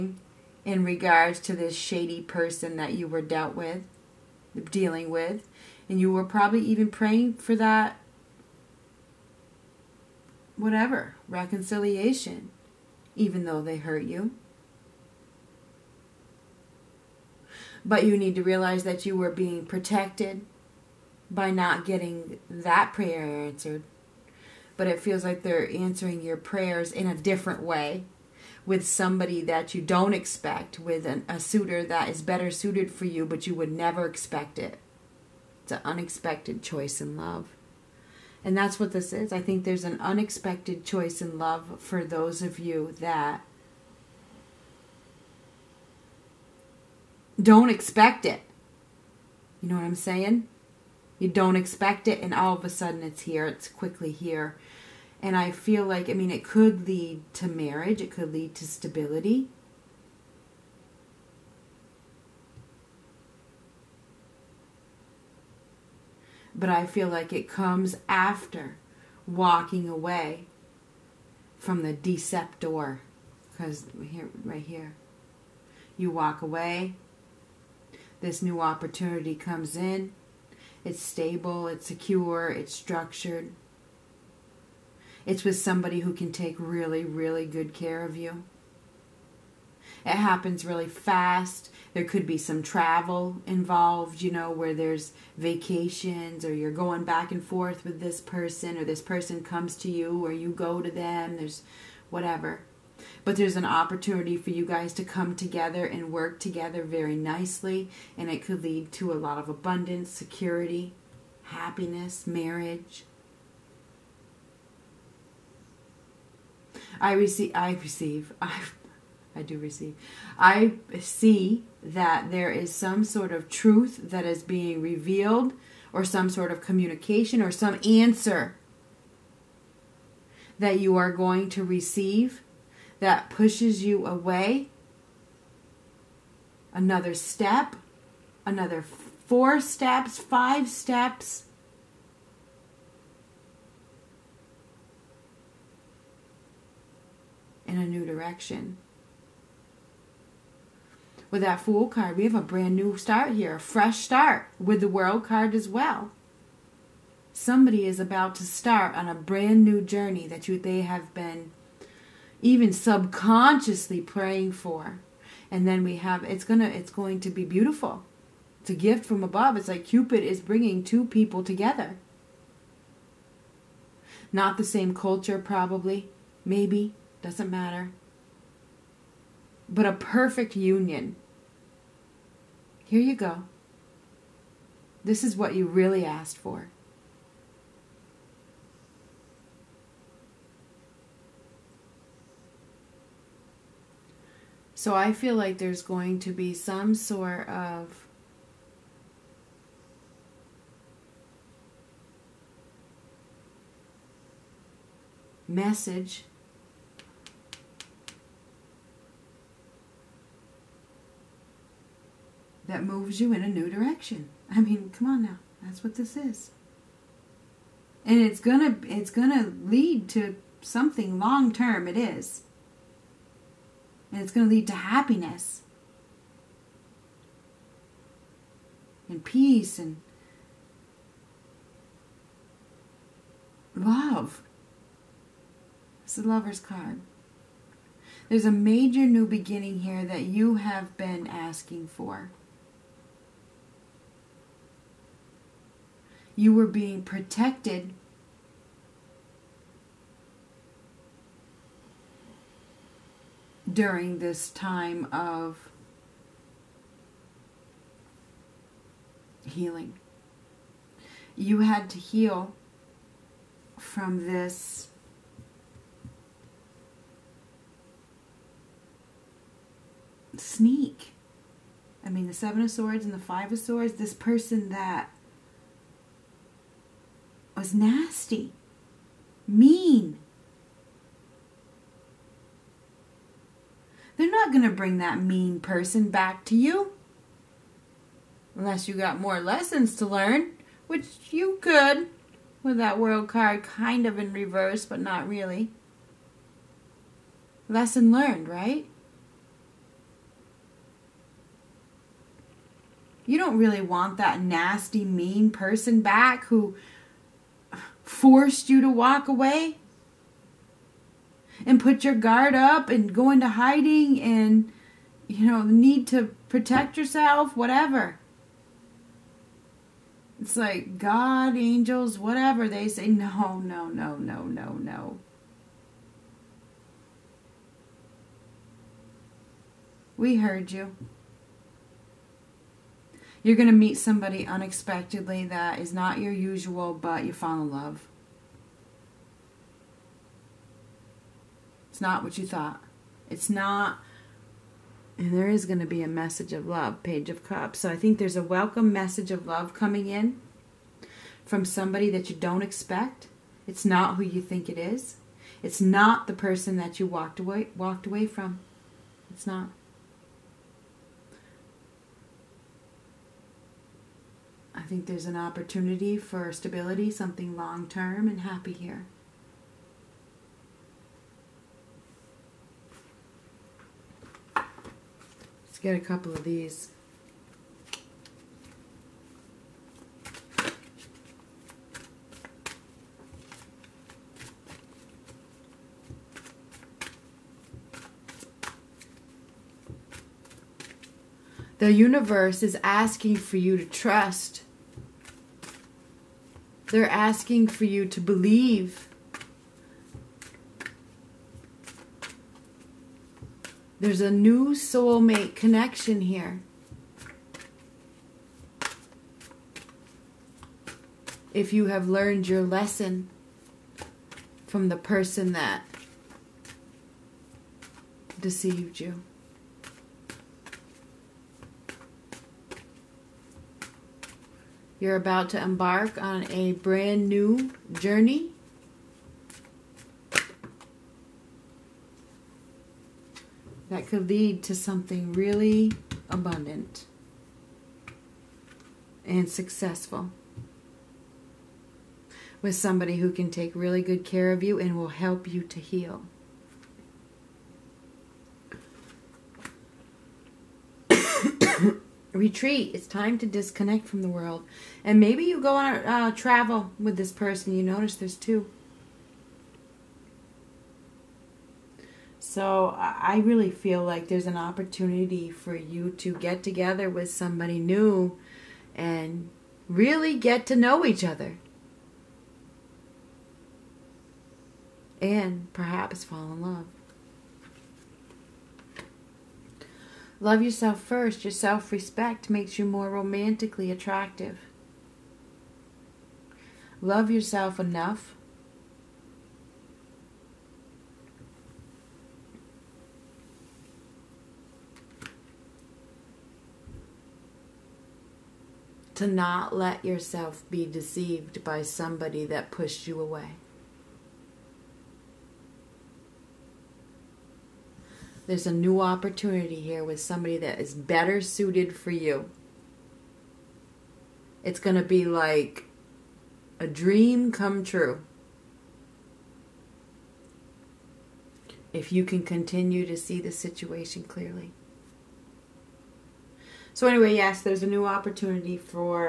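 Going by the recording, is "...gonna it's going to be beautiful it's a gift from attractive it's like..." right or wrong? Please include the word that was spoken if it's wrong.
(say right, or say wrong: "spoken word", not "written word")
wrong: "above", not "attractive".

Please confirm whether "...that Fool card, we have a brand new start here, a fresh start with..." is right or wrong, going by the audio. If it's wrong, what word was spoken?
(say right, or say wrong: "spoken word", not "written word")
right.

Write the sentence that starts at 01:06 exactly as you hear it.
But I feel like it comes after walking away from the deceptor.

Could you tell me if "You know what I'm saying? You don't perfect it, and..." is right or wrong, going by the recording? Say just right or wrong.
wrong.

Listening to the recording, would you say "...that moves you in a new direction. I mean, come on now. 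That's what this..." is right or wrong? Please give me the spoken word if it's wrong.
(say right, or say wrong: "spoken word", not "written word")
right.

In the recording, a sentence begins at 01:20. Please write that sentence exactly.
It's stable, it's secure, it's structured.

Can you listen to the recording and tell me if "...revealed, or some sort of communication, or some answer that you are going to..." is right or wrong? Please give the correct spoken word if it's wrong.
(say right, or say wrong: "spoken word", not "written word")
right.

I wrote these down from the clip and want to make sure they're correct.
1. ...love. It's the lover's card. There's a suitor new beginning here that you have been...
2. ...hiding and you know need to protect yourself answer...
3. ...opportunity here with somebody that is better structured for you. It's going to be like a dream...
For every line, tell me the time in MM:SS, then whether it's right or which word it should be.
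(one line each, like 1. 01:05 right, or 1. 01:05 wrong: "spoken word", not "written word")
1. 03:53 wrong: "major", not "suitor"
2. 05:13 wrong: "whatever", not "answer"
3. 08:29 wrong: "suited", not "structured".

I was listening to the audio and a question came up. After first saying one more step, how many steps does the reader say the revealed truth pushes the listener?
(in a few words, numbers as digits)
4 or 5.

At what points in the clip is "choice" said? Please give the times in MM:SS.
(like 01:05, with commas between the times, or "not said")
00:36, 00:40.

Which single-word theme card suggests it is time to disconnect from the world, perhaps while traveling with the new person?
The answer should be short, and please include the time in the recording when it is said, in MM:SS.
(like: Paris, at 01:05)
Retreat, at 07:32.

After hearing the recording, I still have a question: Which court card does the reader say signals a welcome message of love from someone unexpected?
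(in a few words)
Page of Cups.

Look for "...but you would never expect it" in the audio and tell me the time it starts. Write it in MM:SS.
00:33.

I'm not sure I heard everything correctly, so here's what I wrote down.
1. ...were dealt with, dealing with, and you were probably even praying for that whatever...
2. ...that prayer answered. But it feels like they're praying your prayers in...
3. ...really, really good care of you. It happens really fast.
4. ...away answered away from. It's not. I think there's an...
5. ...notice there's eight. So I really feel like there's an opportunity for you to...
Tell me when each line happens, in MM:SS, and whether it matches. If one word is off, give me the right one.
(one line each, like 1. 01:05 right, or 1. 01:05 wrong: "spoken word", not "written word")
1. 00:03 right
2. 00:22 wrong: "answering", not "praying"
3. 01:26 right
4. 05:57 wrong: "walked", not "answered"
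5. 07:37 wrong: "two", not "eight".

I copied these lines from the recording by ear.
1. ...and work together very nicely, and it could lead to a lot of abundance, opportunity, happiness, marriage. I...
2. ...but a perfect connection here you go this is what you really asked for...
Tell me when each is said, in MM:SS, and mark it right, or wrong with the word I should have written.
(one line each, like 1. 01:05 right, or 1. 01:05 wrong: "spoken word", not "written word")
1. 01:45 wrong: "security", not "opportunity"
2. 02:59 wrong: "union", not "connection".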